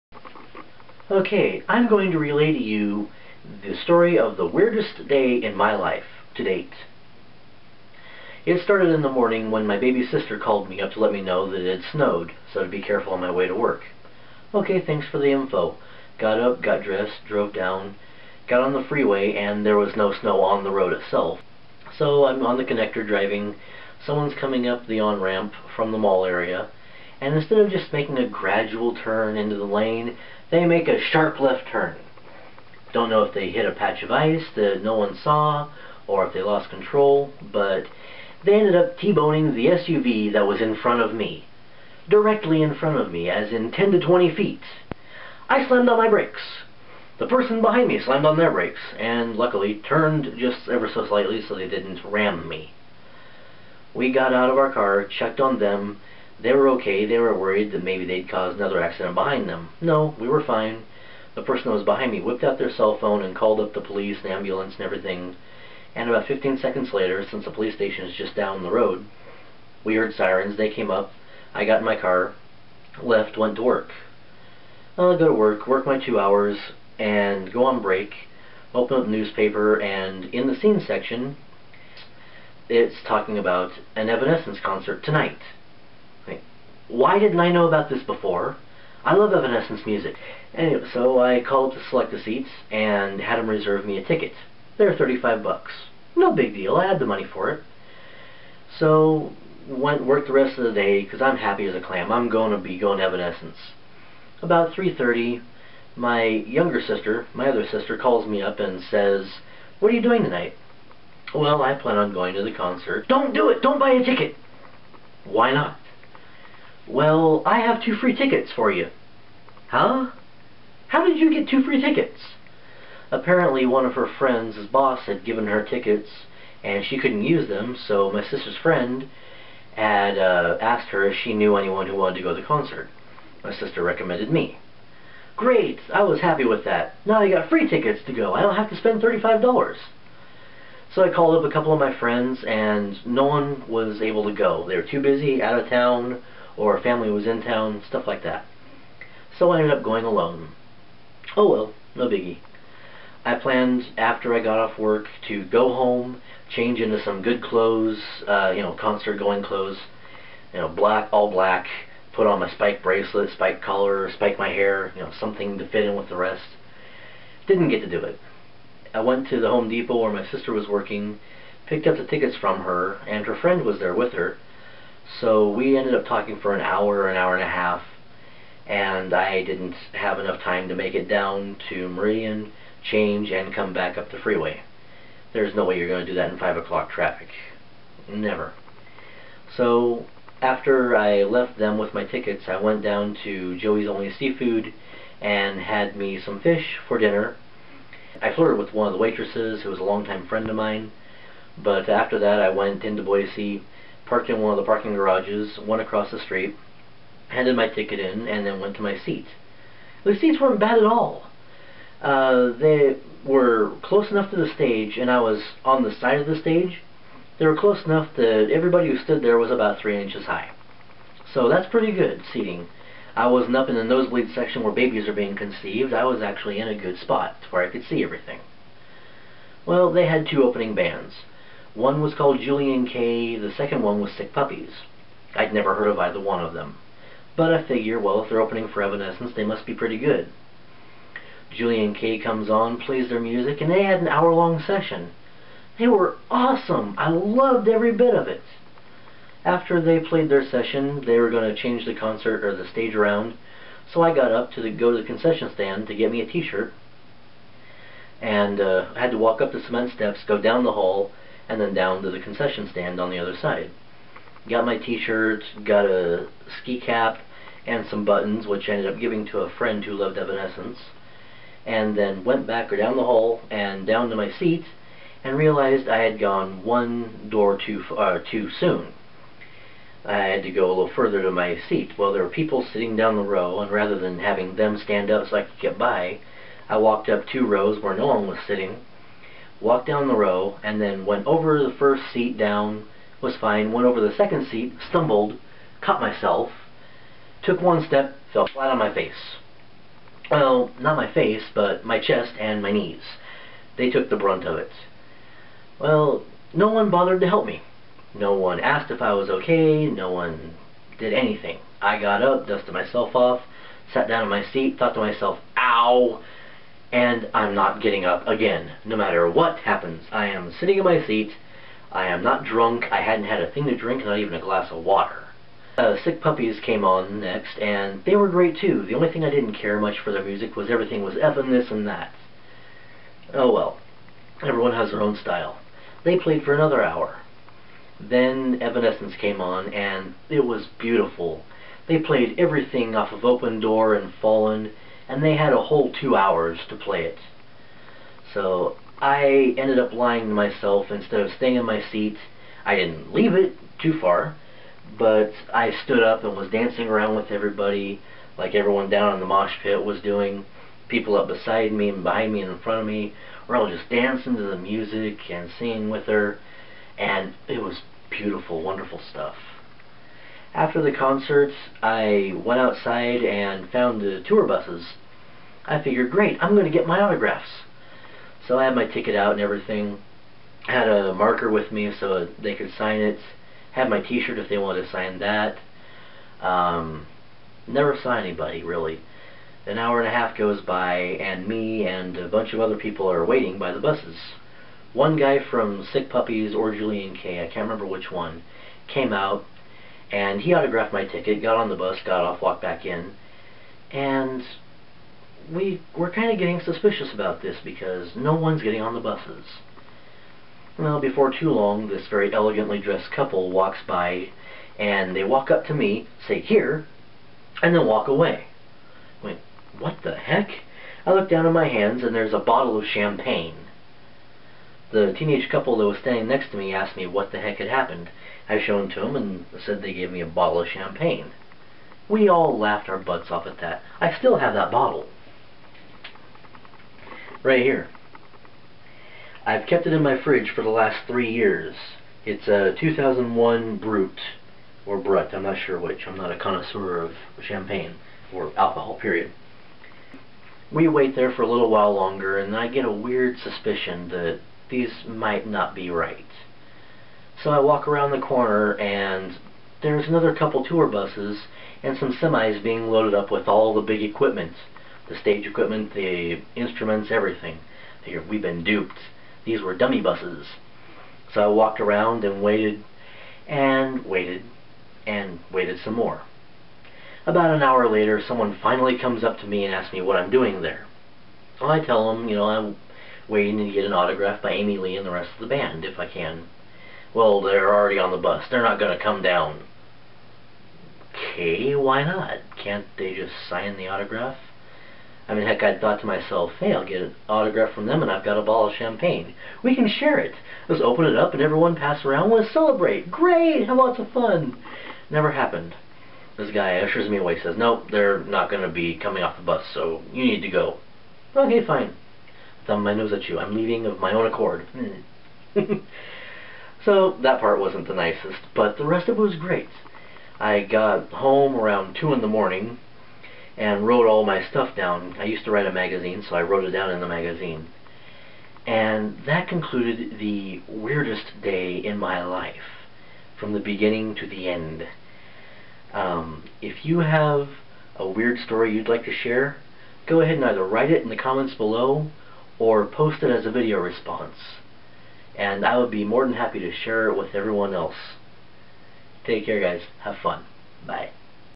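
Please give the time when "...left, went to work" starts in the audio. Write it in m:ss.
1:13.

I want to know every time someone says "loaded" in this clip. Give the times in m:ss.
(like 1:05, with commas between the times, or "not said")
7:42.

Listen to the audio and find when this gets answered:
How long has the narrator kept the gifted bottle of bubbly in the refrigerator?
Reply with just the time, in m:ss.
7:21.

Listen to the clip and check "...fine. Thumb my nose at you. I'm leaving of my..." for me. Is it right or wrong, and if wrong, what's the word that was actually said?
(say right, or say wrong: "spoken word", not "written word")
right.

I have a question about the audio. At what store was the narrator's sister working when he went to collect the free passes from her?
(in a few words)
Home Depot.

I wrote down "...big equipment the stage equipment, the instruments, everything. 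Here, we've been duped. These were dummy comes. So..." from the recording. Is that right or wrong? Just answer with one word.
wrong.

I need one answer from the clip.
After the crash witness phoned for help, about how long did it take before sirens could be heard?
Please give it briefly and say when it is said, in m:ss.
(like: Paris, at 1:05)
15 seconds, at 1:06.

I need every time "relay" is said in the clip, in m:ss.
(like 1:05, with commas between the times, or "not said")
0:02.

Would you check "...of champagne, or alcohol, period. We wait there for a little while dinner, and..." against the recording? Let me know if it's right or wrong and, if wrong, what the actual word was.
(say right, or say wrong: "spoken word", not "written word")
wrong: "longer", not "dinner".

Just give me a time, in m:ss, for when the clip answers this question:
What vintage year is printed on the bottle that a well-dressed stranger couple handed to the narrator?
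7:22.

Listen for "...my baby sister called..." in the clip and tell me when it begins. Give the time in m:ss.
0:09.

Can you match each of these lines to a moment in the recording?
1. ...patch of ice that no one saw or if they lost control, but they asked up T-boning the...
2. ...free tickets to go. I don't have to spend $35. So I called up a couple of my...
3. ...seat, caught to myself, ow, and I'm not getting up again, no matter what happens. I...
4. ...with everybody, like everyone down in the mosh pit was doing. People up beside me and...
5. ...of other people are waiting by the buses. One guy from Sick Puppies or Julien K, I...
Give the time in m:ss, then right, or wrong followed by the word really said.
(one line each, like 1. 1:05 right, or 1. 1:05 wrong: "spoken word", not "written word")
1. 0:33 wrong: "ended", not "asked"
2. 2:17 right
3. 5:14 wrong: "thought", not "caught"
4. 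5:57 right
5. 6:32 right.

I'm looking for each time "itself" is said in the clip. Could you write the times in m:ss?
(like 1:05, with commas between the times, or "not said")
0:20.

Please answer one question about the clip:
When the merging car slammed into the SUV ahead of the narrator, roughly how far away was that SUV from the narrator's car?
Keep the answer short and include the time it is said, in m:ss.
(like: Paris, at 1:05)
10 to 20 feet, at 0:43.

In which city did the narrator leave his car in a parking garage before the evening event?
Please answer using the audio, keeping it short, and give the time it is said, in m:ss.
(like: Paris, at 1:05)
Boise, at 3:23.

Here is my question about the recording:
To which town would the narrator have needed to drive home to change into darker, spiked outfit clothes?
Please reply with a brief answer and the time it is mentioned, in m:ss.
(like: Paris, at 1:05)
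Meridian, at 3:01.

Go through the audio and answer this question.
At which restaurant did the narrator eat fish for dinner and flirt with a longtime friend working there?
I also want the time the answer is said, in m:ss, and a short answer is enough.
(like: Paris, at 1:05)
Joey's Only Seafood, at 3:13.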